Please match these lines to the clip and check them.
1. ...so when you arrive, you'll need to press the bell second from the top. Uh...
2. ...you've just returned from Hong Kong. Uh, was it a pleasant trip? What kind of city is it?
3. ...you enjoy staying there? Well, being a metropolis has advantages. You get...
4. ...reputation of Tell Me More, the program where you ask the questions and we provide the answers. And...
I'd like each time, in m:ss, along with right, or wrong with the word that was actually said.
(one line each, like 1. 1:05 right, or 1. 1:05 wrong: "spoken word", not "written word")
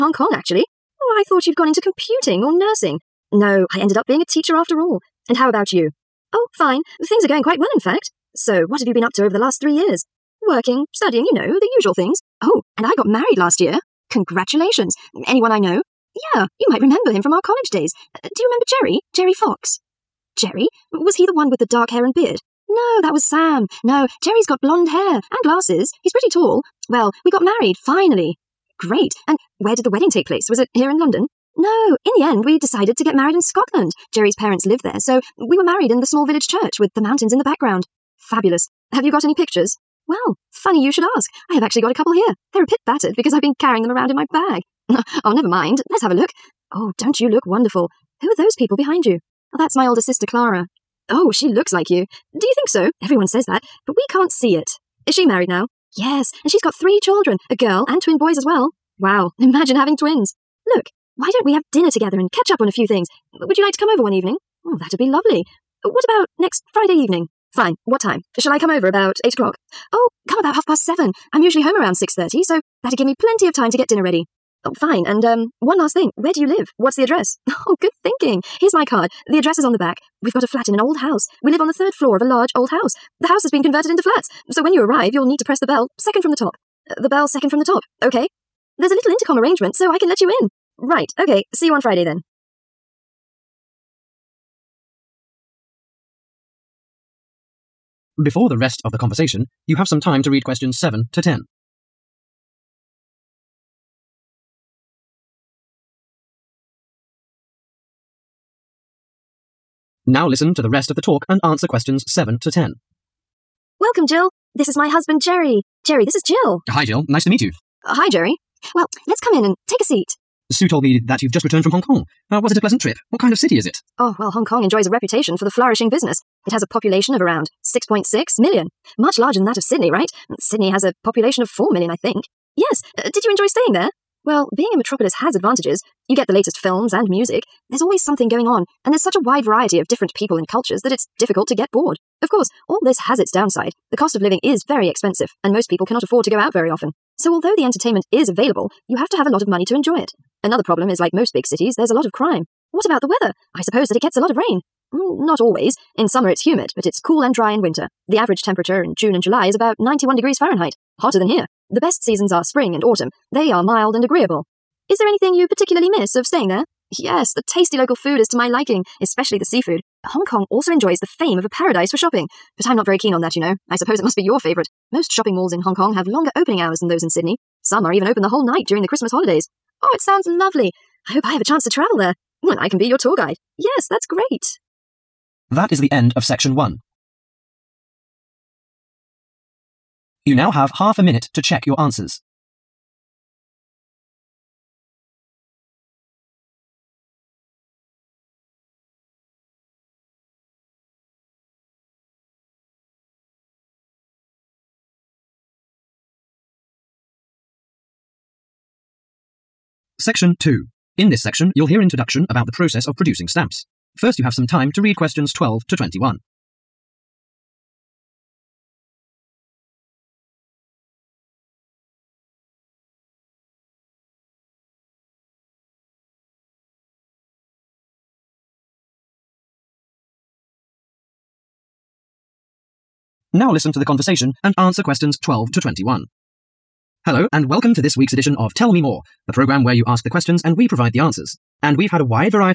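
1. 1:24 right
2. 2:01 right
3. 2:13 right
4. 3:58 wrong: "edition", not "reputation".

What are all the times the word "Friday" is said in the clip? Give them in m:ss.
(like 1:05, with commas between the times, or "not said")
1:06, 1:31.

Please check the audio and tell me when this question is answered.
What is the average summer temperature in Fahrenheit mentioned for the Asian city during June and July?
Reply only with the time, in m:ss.
2:39.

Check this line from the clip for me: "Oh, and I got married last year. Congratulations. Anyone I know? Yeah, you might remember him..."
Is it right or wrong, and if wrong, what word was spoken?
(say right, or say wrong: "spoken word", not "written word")
right.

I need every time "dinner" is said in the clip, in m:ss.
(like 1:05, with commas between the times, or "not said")
1:01, 1:13.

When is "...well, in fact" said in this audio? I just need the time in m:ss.
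0:07.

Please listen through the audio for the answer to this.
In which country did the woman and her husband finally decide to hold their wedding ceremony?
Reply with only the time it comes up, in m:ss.
0:33.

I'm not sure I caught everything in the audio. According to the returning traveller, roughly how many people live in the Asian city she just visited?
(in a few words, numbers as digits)
6.6 million.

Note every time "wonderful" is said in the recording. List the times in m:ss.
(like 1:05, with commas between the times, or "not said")
0:47.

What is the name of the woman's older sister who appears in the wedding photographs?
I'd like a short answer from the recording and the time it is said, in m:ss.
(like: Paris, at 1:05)
Clara, at 0:50.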